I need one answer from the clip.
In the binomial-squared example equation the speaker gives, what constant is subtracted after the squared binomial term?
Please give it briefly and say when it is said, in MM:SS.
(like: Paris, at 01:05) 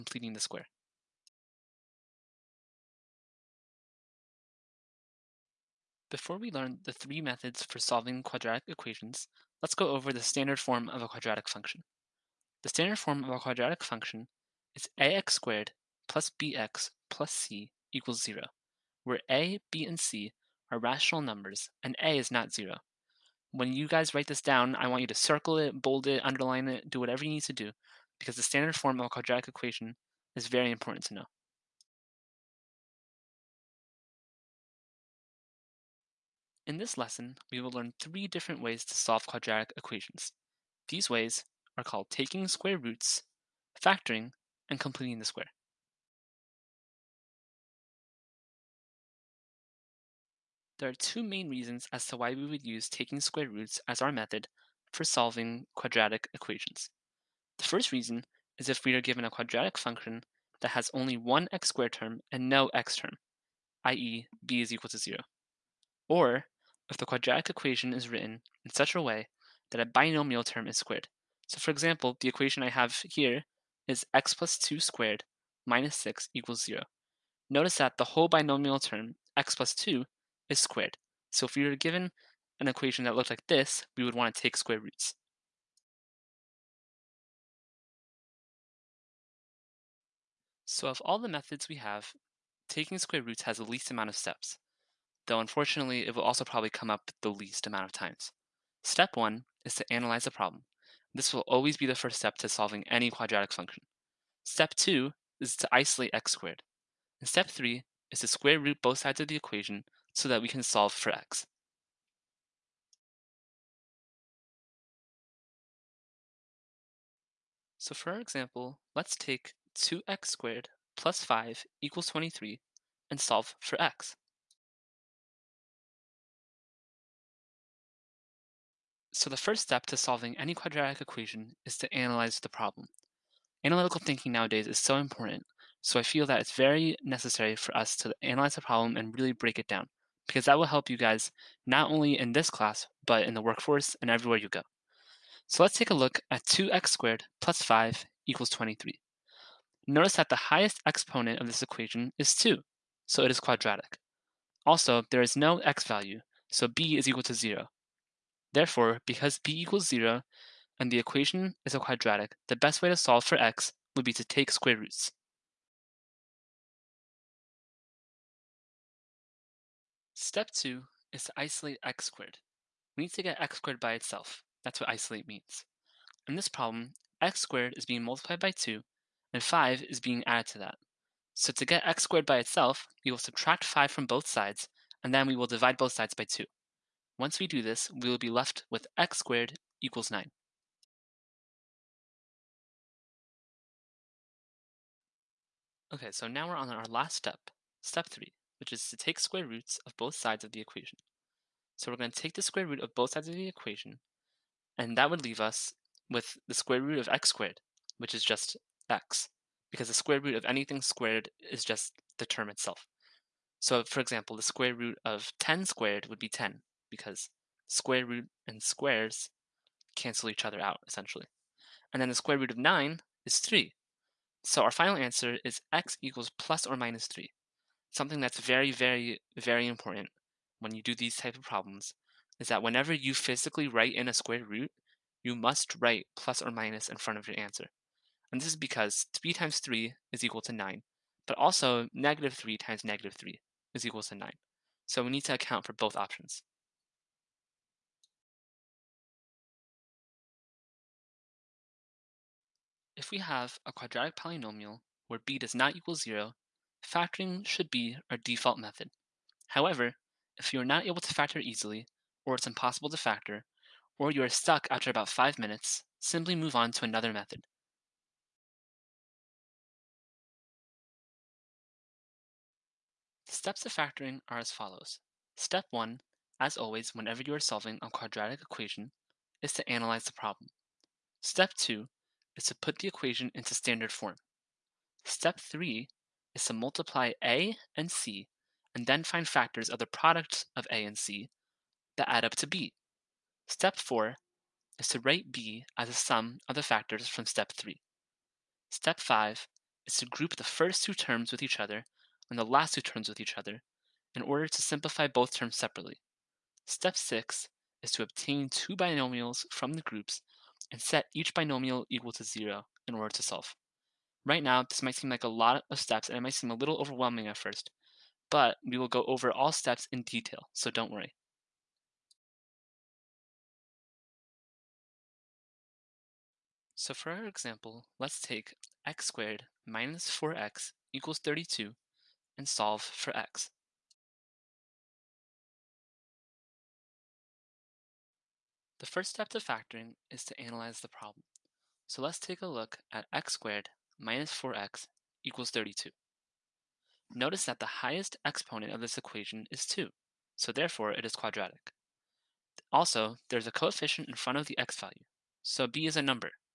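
6, at 01:15.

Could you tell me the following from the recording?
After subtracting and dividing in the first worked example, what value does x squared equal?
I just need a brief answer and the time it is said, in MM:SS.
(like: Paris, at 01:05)
9, at 03:08.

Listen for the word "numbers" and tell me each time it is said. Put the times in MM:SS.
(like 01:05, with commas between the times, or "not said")
00:21, 05:56.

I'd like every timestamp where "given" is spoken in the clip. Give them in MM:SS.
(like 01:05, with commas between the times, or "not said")
00:59, 01:21.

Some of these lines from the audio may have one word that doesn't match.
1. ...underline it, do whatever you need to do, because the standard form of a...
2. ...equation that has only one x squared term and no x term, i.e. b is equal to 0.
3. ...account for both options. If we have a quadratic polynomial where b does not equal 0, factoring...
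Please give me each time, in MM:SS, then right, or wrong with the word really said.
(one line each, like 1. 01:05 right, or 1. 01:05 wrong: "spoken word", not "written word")
1. 00:26 right
2. 00:59 wrong: "function", not "equation"
3. 04:05 right.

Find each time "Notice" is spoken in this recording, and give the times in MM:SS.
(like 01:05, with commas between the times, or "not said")
01:17, 02:29, 05:47.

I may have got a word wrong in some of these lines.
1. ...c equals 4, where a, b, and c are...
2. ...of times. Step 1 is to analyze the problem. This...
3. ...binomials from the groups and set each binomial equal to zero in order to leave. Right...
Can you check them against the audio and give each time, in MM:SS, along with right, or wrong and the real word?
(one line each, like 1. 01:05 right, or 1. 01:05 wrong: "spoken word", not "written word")
1. 00:17 wrong: "0", not "4"
2. 01:37 right
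3. 05:08 wrong: "solve", not "leave".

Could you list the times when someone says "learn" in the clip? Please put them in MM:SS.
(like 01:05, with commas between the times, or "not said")
00:06, 00:37.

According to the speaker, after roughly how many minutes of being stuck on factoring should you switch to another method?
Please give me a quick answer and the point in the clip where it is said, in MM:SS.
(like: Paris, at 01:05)
5 minutes, at 04:25.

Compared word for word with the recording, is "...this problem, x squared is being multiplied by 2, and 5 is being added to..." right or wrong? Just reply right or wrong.
right.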